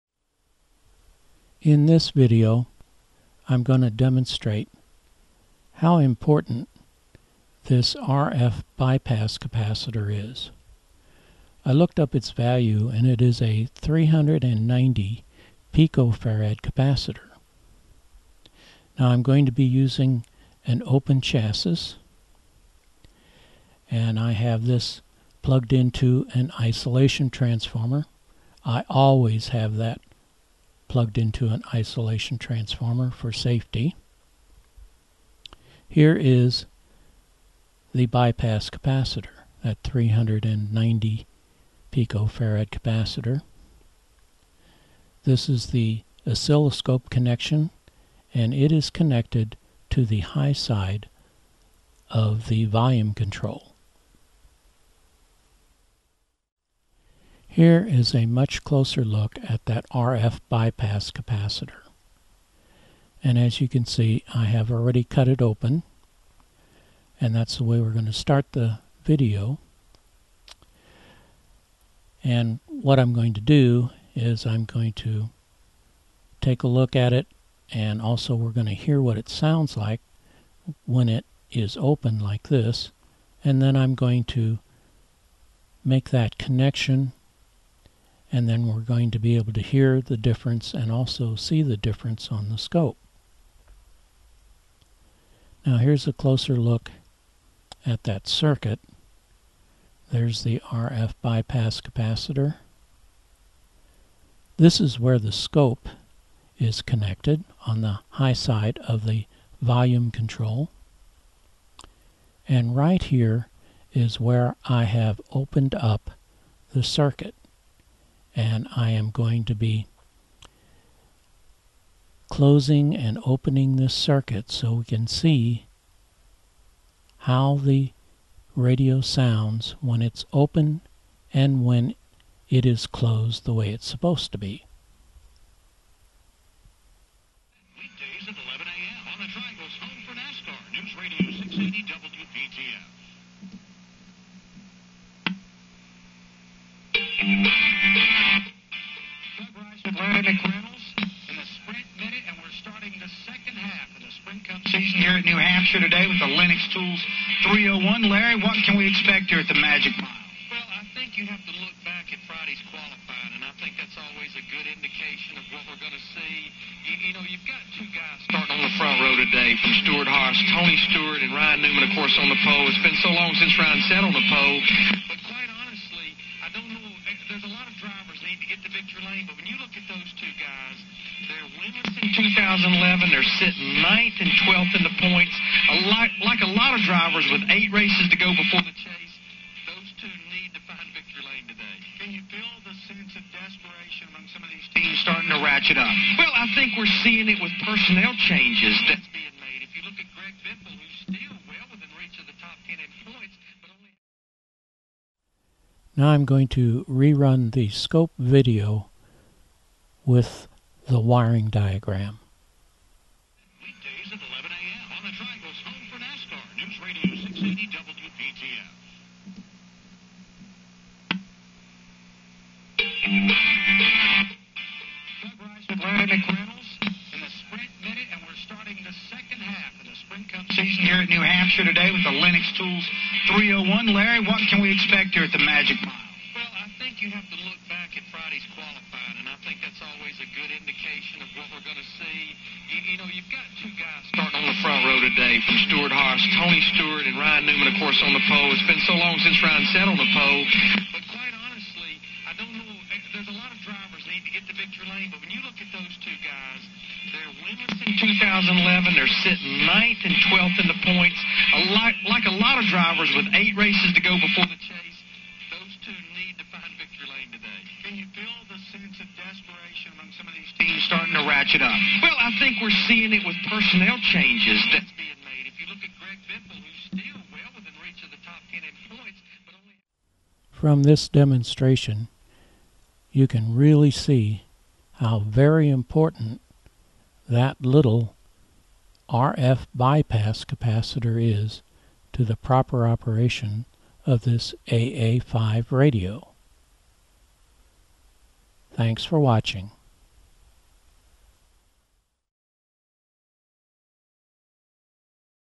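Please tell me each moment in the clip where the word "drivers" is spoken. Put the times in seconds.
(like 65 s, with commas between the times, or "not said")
186 s, 253 s, 262 s.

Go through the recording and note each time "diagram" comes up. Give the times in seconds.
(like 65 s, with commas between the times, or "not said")
211 s.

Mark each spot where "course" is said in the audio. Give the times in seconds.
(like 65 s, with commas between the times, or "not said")
171 s, 247 s.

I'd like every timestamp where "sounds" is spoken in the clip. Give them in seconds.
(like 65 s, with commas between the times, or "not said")
79 s, 129 s.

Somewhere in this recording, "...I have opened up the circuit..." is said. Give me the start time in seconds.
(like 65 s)
114 s.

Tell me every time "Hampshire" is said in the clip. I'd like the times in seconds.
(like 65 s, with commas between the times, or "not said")
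155 s, 231 s.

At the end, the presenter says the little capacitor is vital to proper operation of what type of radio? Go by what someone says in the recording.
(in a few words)
AA5.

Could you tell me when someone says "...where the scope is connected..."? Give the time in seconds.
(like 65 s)
104 s.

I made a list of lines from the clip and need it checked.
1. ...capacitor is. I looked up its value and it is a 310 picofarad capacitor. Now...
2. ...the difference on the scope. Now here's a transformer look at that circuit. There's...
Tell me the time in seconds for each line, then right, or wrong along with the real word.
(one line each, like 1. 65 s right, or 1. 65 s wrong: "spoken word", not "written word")
1. 9 s wrong: "390", not "310"
2. 91 s wrong: "closer", not "transformer".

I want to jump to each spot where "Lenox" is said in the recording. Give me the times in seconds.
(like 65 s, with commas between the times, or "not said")
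156 s, 232 s.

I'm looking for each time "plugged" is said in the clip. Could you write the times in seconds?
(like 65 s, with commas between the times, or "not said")
25 s, 30 s.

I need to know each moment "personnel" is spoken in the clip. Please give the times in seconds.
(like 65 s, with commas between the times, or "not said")
197 s, 273 s.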